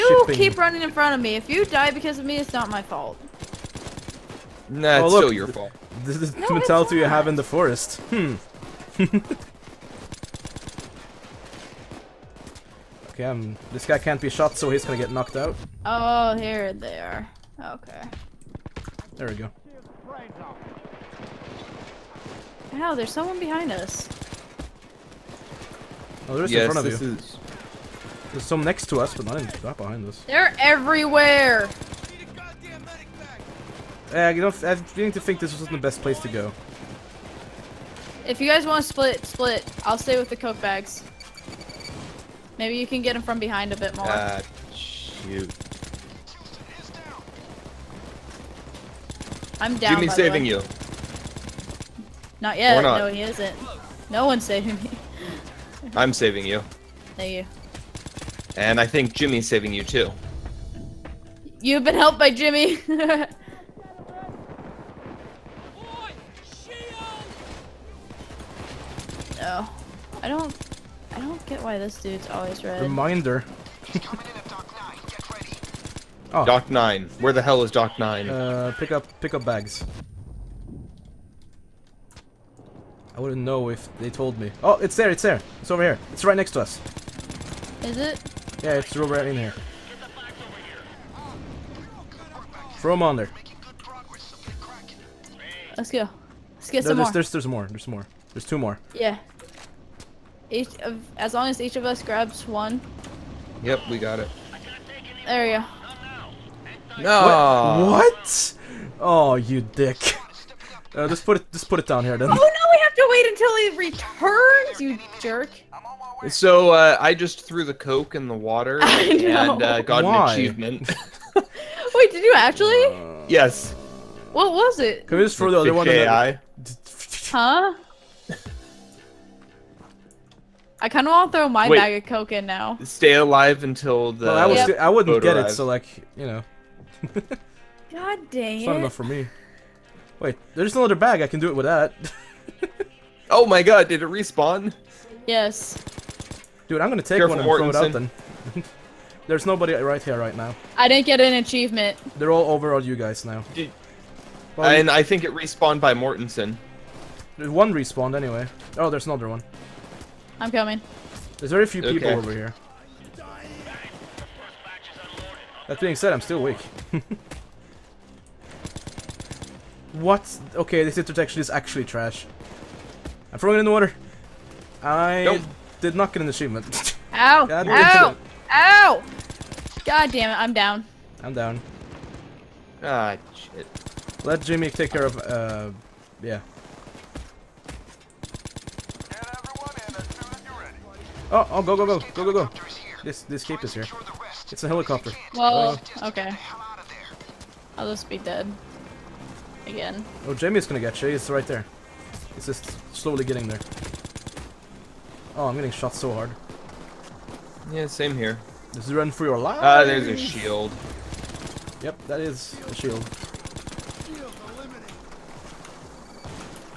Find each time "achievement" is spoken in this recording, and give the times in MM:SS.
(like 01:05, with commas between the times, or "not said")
02:00, 02:31, 02:56.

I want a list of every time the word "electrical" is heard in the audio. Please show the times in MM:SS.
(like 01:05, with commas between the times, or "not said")
not said.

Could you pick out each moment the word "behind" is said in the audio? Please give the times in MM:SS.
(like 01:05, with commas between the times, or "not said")
00:23, 00:29, 00:43.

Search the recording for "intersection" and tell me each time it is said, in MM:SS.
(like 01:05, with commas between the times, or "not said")
02:50.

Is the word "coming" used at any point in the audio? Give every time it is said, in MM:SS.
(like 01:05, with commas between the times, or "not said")
02:40.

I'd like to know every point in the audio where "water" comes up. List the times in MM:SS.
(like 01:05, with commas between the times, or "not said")
01:58, 02:53.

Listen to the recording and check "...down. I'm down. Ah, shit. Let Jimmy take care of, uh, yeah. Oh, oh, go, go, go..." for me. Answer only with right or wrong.
right.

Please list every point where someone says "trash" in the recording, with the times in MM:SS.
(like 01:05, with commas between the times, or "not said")
02:51.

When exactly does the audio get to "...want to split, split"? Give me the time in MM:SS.
00:38.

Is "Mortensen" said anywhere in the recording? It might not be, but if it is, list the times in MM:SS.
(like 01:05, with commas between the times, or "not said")
02:27, 02:35.